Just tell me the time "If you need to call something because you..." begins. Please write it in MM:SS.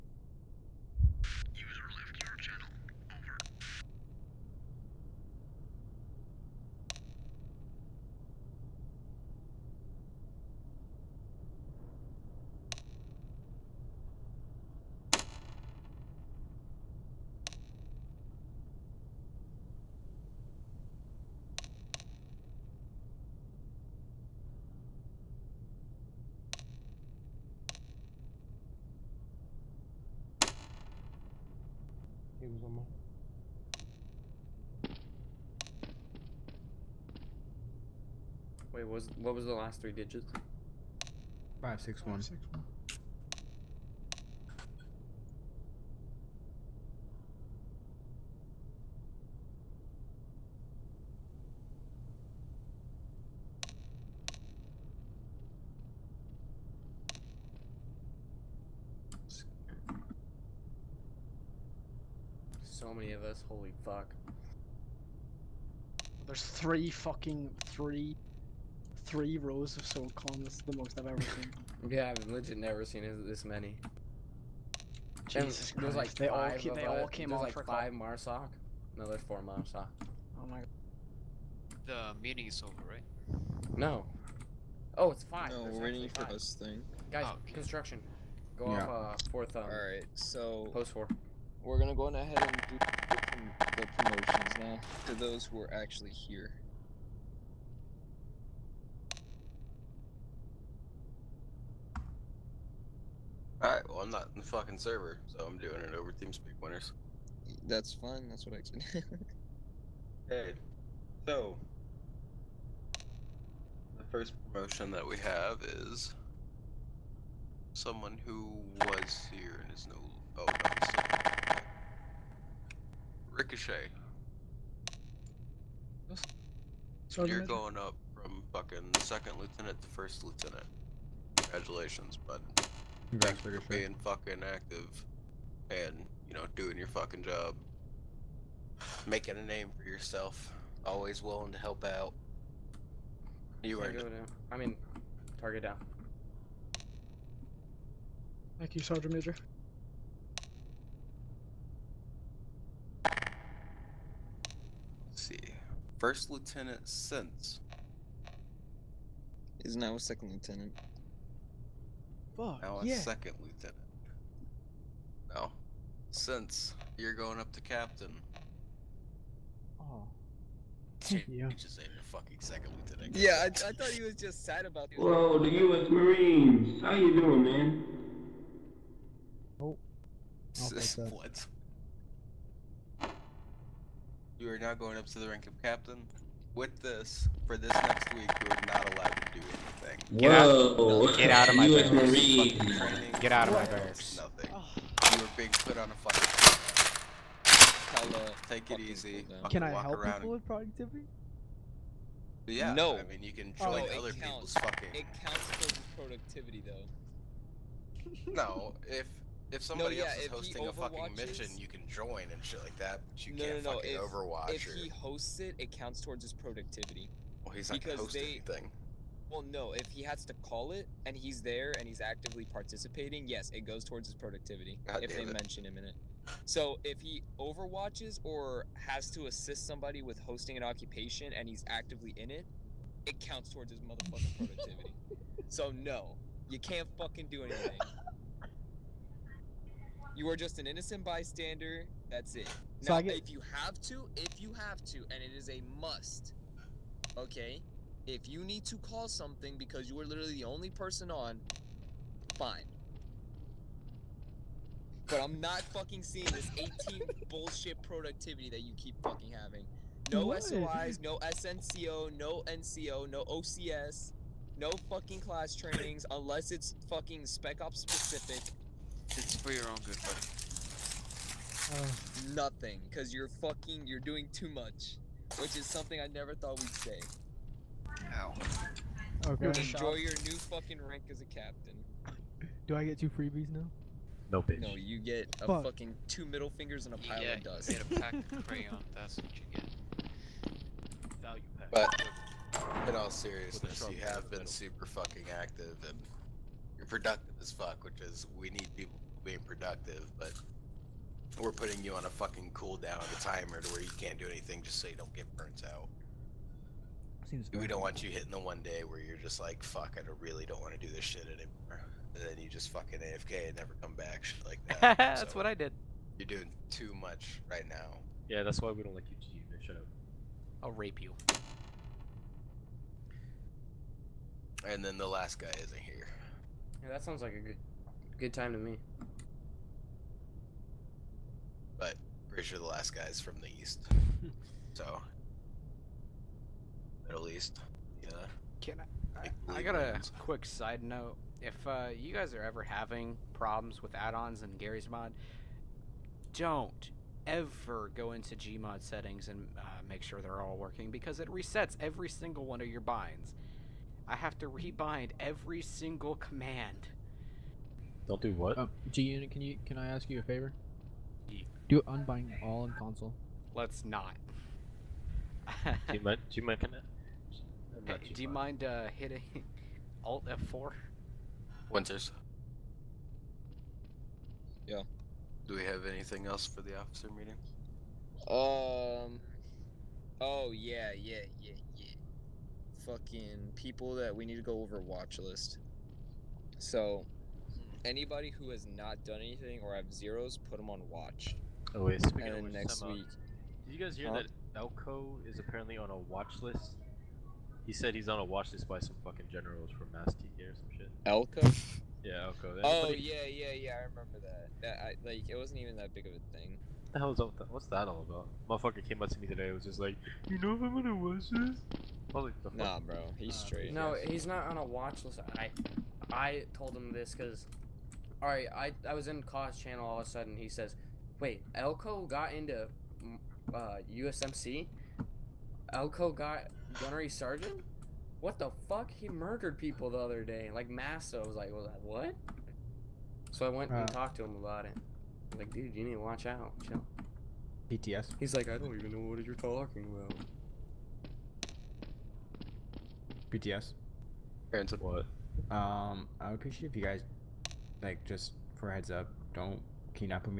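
04:08.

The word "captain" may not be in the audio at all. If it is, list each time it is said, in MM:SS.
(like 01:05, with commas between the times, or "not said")
02:47, 03:05, 04:41.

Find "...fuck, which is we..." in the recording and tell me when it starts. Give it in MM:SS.
04:57.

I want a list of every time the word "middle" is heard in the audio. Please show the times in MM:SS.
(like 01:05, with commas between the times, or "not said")
04:46, 05:37.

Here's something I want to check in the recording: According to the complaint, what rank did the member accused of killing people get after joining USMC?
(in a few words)
Gunnery sergeant.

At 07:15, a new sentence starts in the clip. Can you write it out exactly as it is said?
like, dude, you need to watch out.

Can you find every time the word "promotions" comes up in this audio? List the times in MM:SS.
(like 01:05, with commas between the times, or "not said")
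01:34, 01:54.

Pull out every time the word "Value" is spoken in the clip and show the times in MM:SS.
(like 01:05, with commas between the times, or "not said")
04:51.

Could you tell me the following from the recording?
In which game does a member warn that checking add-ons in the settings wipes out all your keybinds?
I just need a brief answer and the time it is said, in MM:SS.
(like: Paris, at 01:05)
Garry's Mod, at 05:44.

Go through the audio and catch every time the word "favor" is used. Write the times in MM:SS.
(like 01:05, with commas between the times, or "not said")
06:00.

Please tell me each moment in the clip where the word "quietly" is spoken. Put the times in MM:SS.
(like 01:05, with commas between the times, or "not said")
not said.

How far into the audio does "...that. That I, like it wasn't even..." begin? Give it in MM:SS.
06:44.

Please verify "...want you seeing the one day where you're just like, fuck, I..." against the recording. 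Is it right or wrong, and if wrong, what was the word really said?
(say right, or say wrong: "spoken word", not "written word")
wrong: "hitting", not "seeing".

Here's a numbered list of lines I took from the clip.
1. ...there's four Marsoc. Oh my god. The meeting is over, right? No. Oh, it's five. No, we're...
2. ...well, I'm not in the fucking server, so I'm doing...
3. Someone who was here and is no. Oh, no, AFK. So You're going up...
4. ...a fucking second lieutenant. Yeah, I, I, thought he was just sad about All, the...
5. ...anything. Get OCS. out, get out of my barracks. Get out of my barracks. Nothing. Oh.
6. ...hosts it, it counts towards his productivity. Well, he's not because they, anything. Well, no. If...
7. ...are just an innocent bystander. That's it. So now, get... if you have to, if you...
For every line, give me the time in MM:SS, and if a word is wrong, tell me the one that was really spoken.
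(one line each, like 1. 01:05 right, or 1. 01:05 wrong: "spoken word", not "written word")
1. 01:19 right
2. 01:43 right
3. 01:57 wrong: "Ricochet", not "AFK"
4. 02:51 wrong: "Whoa", not "All"
5. 03:09 wrong: "Whoa", not "OCS"
6. 03:34 right
7. 04:00 right.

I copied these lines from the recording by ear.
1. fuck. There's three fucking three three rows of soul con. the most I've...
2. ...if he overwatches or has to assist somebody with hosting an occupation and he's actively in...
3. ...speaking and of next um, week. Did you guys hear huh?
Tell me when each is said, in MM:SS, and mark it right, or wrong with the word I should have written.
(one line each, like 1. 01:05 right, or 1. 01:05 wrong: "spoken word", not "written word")
1. 01:03 right
2. 03:46 right
3. 06:32 right.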